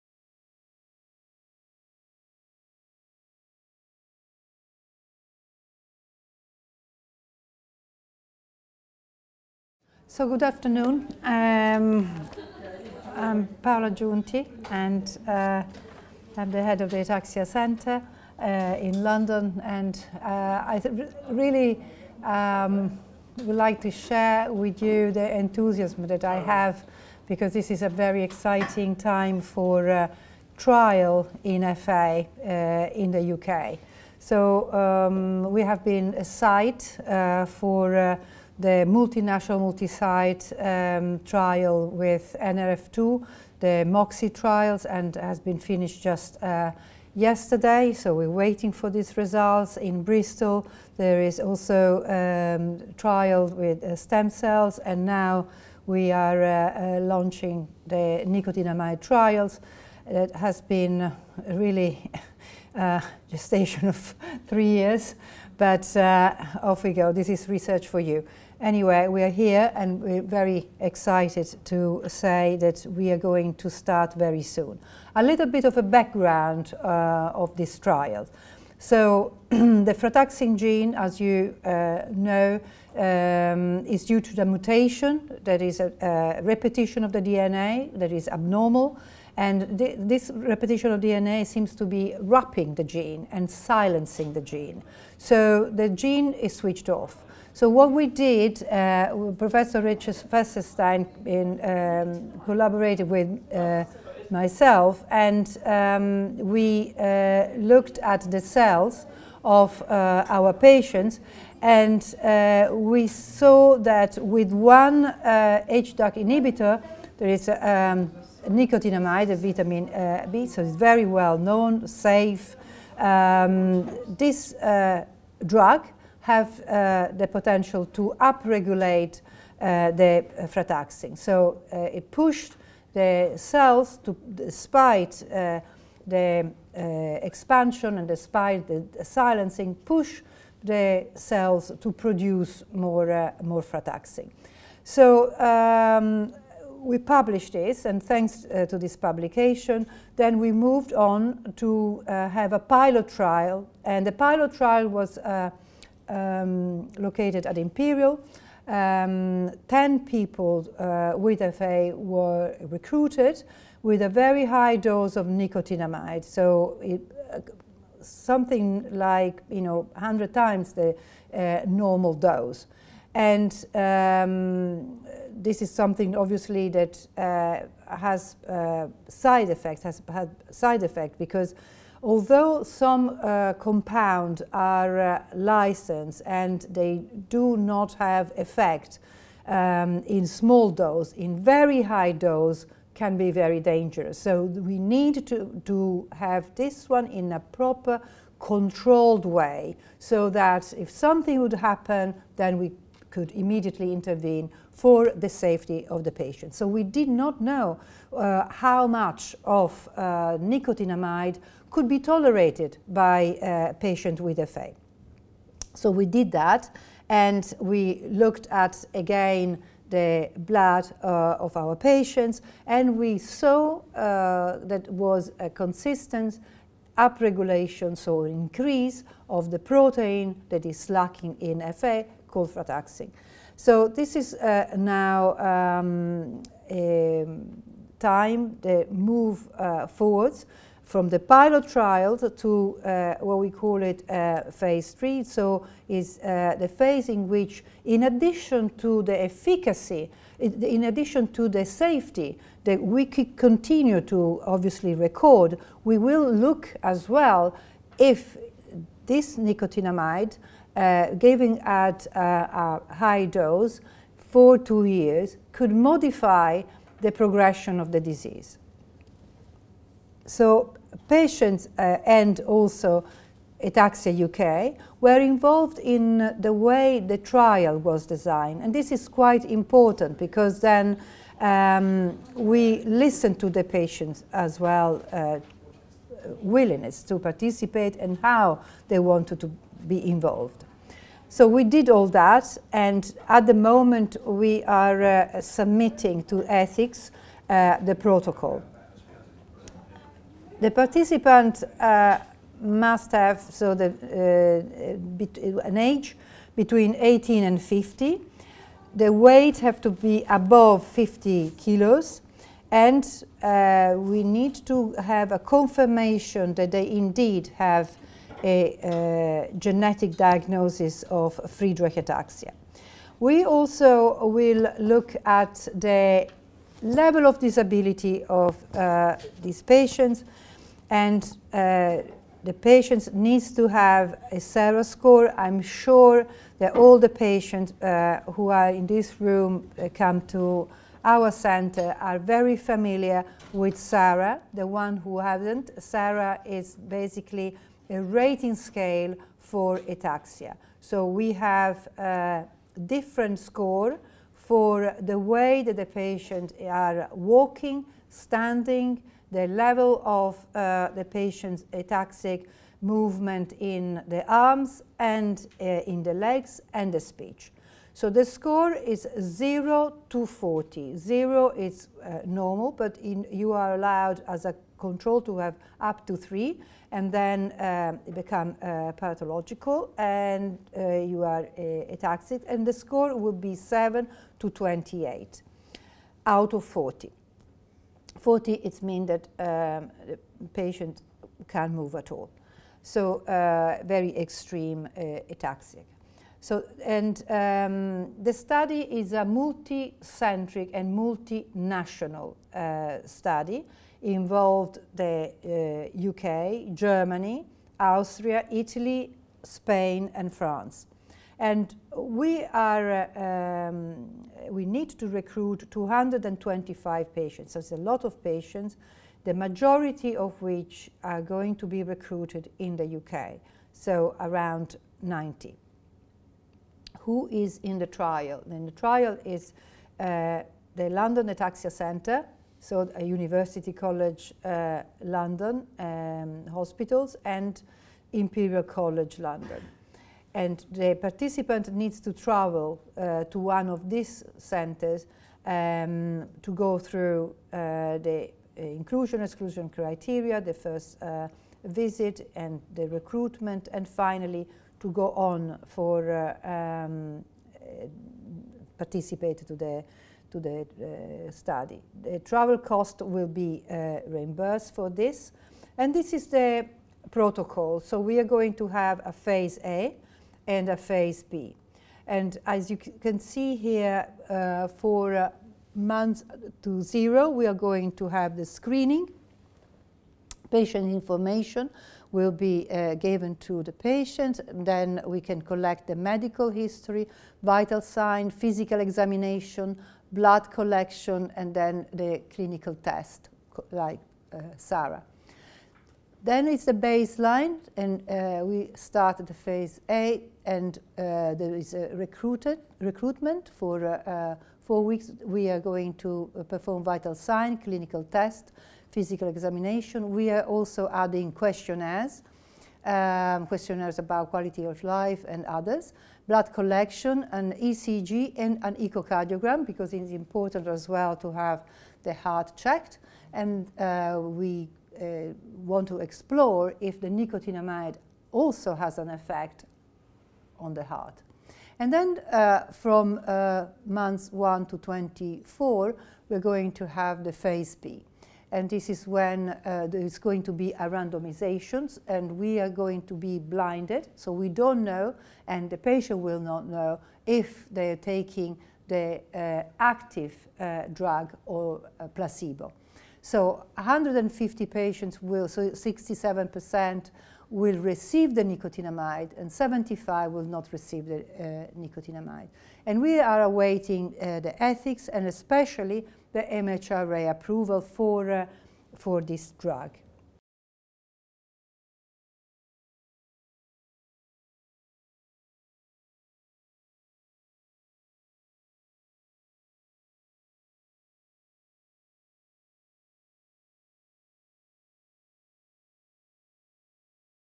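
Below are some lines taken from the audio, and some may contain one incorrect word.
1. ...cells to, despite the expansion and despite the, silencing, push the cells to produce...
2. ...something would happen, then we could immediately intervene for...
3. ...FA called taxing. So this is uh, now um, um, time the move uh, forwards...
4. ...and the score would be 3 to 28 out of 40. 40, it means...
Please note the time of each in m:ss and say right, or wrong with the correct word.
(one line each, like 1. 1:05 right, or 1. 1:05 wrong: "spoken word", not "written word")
1. 2:13 right
2. 3:20 right
3. 3:51 right
4. 6:22 wrong: "7", not "3".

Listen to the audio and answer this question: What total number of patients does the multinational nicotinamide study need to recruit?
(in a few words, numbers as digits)
225.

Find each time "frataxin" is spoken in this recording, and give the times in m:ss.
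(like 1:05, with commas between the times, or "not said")
1:19, 2:10, 2:23.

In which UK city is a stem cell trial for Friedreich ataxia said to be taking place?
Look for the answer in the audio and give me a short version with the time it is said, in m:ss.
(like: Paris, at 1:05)
Bristol, at 0:50.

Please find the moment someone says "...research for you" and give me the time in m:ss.
1:07.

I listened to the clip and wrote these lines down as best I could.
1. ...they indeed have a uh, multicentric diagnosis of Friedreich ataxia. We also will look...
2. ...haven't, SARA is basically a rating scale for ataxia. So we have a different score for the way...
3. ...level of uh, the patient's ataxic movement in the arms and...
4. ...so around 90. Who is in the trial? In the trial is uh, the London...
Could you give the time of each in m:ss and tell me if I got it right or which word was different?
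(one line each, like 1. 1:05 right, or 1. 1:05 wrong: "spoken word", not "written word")
1. 5:16 wrong: "genetic", not "multicentric"
2. 5:45 right
3. 5:59 right
4. 7:03 right.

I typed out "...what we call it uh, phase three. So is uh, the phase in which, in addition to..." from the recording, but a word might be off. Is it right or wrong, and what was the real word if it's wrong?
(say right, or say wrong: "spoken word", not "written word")
right.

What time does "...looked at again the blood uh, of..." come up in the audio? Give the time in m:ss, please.
3:38.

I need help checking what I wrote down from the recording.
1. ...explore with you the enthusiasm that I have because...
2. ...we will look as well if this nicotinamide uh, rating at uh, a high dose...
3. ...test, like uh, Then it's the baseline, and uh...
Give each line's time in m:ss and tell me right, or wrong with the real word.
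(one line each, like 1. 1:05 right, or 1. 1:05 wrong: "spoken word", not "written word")
1. 0:23 wrong: "share", not "explore"
2. 4:15 wrong: "giving", not "rating"
3. 8:12 right.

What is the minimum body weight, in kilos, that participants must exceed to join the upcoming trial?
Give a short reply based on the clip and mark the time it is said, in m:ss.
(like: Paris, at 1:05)
50 kilos, at 5:10.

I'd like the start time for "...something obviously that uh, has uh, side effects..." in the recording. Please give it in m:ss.
2:55.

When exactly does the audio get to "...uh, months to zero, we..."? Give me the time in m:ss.
7:55.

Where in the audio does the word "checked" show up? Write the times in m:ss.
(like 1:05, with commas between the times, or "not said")
8:42.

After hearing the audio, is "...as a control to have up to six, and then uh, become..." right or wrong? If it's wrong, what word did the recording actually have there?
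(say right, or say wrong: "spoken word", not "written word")
wrong: "three", not "six".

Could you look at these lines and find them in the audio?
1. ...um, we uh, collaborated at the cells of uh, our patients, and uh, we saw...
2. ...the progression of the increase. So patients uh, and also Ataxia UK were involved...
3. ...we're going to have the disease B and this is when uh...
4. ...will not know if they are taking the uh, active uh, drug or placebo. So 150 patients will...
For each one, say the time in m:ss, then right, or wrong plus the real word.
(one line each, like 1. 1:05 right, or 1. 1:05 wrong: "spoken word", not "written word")
1. 1:45 wrong: "looked", not "collaborated"
2. 4:27 wrong: "disease", not "increase"
3. 8:56 wrong: "phase", not "disease"
4. 9:06 right.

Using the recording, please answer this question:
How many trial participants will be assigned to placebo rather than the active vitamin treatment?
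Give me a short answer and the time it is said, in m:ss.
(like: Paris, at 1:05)
75, at 9:19.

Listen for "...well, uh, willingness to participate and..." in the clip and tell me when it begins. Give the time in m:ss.
4:44.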